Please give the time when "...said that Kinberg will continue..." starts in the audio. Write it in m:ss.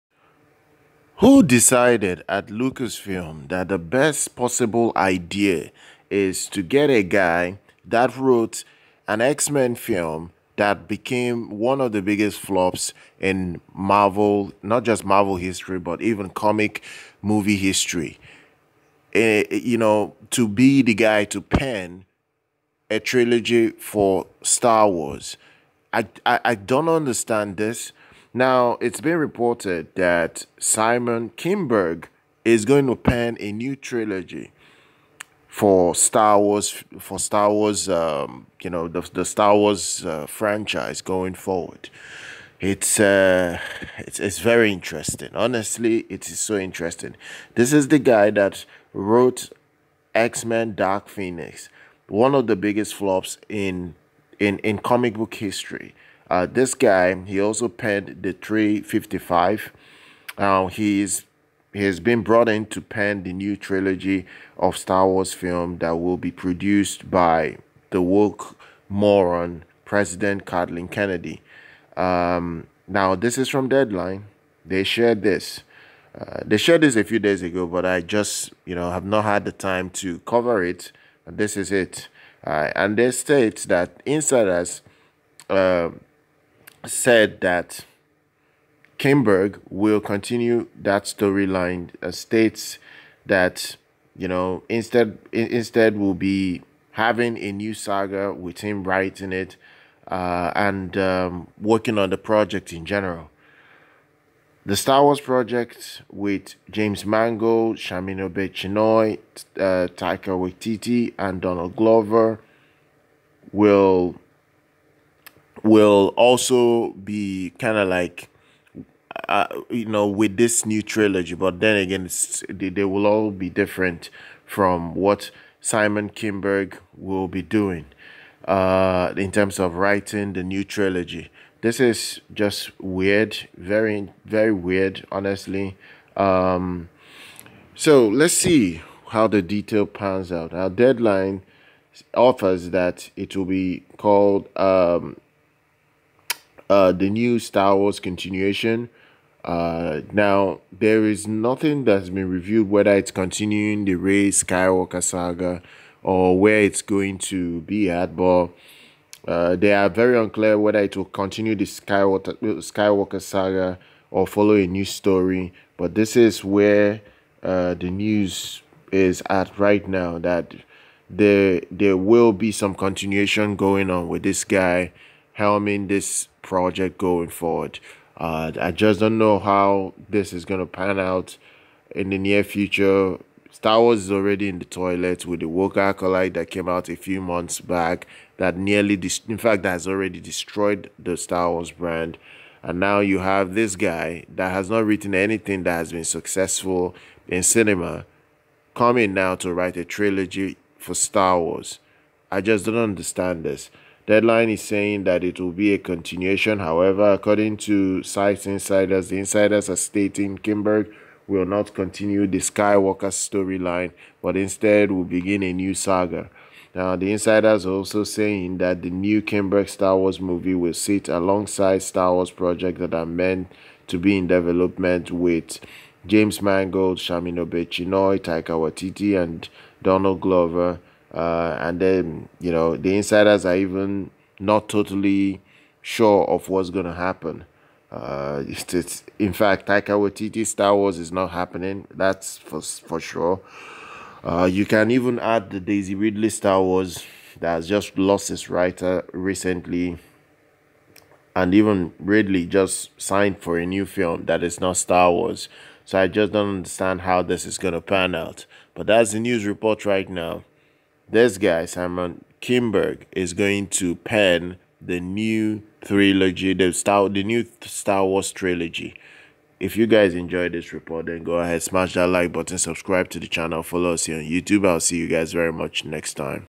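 1:26.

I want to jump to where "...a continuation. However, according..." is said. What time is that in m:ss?
3:25.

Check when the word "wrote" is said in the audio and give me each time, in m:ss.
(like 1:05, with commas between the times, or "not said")
0:08, 0:48.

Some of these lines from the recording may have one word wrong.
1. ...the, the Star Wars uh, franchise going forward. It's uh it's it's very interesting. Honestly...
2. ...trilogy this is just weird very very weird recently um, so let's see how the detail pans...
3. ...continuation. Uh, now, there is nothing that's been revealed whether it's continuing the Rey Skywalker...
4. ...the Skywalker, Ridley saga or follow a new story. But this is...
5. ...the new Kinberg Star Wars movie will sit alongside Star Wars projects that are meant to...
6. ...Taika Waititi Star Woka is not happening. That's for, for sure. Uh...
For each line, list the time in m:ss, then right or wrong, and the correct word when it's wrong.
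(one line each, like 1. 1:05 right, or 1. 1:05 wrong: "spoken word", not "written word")
1. 0:38 right
2. 2:10 wrong: "honestly", not "recently"
3. 2:27 right
4. 2:41 wrong: "Skywalker", not "Ridley"
5. 3:38 right
6. 3:59 wrong: "Wars", not "Woka".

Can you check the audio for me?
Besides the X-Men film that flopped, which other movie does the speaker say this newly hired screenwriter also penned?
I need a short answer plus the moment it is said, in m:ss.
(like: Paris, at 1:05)
The 355, at 0:58.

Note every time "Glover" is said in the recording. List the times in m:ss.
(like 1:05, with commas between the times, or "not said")
1:51, 3:50.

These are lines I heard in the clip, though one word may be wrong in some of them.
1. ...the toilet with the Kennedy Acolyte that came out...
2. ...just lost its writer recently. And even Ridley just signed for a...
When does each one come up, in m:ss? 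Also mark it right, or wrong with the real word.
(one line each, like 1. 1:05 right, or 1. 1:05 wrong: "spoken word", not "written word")
1. 3:04 wrong: "Woka", not "Kennedy"
2. 4:07 right.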